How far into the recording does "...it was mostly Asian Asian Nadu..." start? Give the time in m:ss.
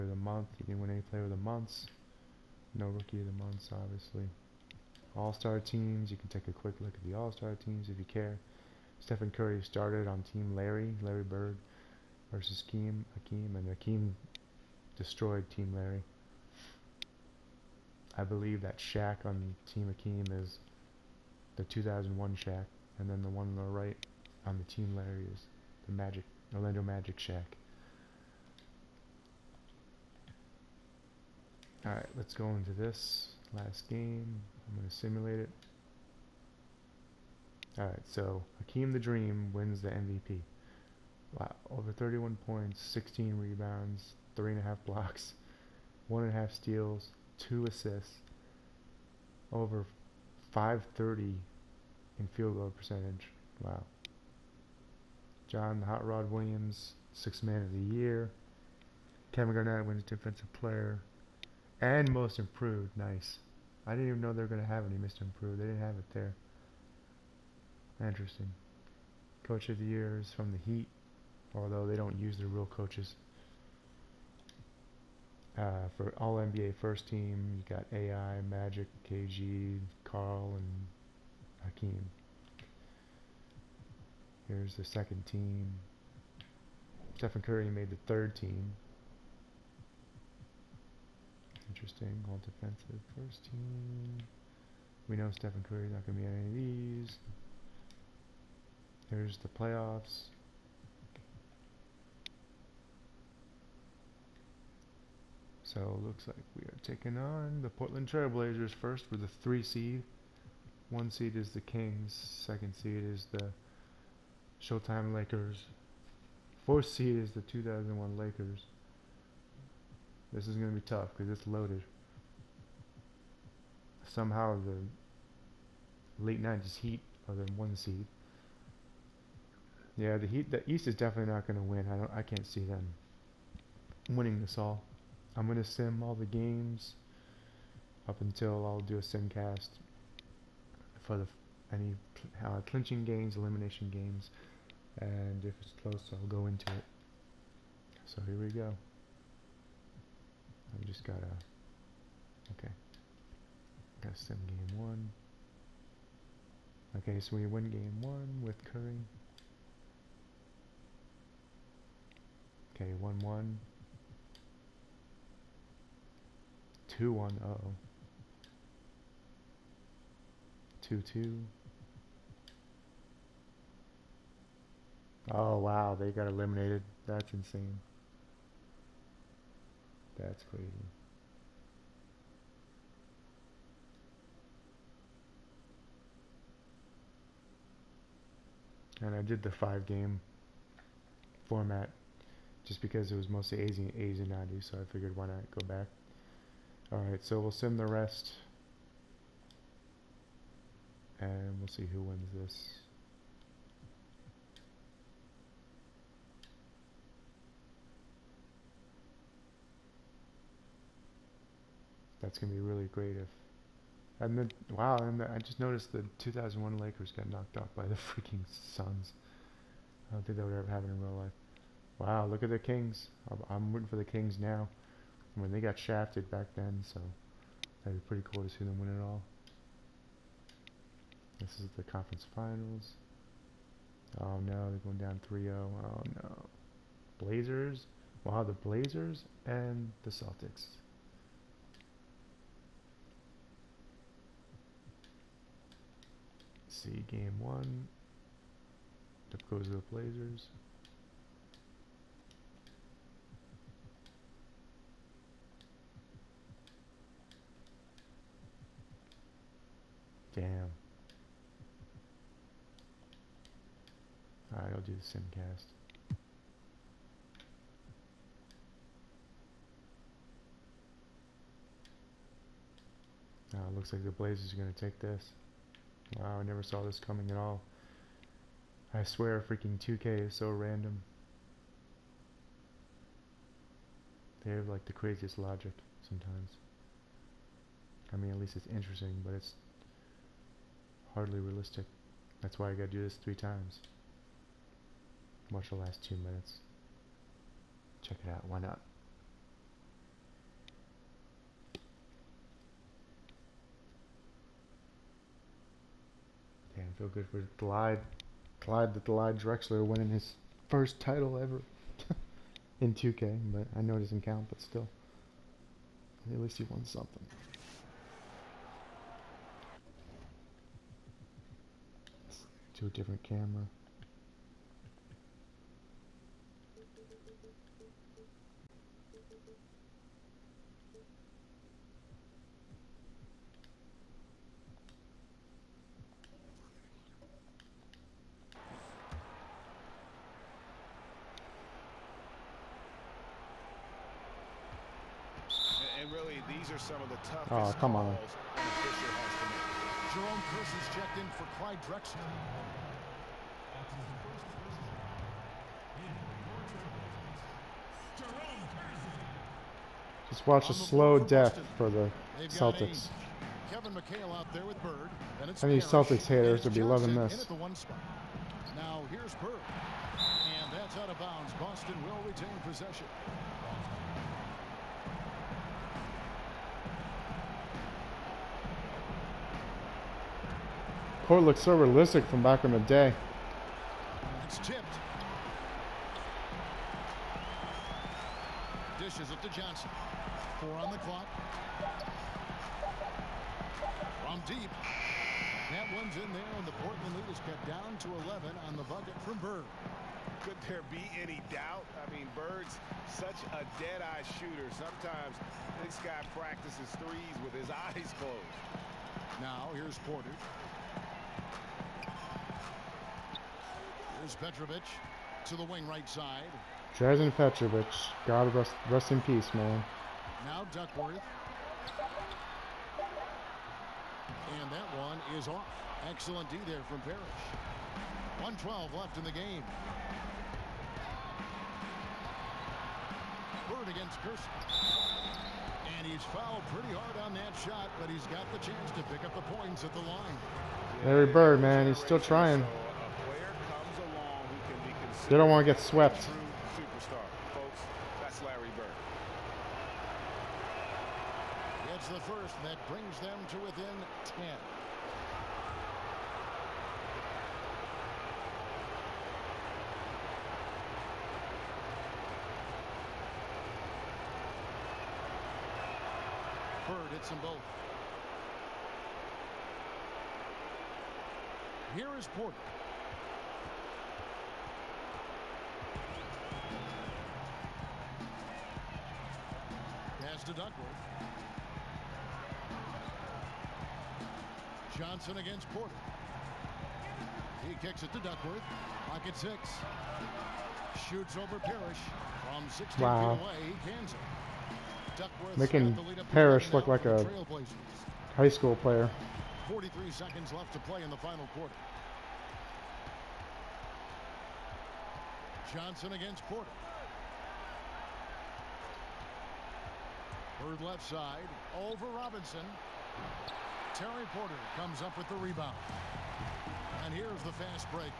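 3:13.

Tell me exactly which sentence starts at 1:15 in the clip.
Uh, for all NBA first team, you got AI, Magic, KG, Karl, and Hakeem.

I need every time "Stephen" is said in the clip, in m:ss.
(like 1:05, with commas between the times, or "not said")
0:08, 1:27, 1:35.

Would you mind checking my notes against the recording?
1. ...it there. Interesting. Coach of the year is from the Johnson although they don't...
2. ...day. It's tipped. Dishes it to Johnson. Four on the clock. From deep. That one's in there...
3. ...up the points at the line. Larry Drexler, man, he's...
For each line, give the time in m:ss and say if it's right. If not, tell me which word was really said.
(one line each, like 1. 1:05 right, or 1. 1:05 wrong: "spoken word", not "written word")
1. 1:05 wrong: "Heat", not "Johnson"
2. 6:22 right
3. 7:19 wrong: "Bird", not "Drexler".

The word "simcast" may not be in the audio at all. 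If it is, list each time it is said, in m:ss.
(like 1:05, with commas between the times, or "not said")
2:19, 4:25.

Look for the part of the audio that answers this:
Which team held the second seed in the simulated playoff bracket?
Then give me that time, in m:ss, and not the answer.
1:54.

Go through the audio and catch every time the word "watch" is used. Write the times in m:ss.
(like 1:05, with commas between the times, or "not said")
4:55, 6:00.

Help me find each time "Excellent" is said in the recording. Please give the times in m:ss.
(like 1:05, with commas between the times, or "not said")
7:06.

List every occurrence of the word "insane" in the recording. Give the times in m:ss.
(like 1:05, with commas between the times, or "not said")
2:57.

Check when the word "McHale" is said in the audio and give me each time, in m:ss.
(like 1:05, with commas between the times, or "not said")
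6:03.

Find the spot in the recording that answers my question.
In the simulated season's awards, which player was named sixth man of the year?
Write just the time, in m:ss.
0:55.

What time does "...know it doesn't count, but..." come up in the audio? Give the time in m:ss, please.
5:13.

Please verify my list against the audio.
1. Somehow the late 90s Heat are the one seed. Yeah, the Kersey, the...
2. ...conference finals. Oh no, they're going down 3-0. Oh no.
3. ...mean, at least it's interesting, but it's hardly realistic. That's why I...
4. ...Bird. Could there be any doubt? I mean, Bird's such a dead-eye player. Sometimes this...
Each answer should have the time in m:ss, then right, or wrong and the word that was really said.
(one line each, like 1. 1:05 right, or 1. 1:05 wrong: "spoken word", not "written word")
1. 2:04 wrong: "Heat", not "Kersey"
2. 3:51 right
3. 4:48 right
4. 6:39 wrong: "shooter", not "player".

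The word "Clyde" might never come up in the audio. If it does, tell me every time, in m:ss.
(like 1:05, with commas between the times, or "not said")
5:08, 5:51.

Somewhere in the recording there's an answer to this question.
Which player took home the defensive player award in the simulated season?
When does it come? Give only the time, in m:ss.
0:59.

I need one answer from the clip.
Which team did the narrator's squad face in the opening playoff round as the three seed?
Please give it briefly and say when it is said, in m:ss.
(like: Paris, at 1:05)
Portland Trailblazers, at 1:47.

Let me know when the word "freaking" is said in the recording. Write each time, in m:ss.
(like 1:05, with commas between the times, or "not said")
3:37, 4:39.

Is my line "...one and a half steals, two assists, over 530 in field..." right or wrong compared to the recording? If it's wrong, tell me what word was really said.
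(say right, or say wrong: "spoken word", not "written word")
right.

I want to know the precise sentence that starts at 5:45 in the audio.
And really, these are some of the toughest.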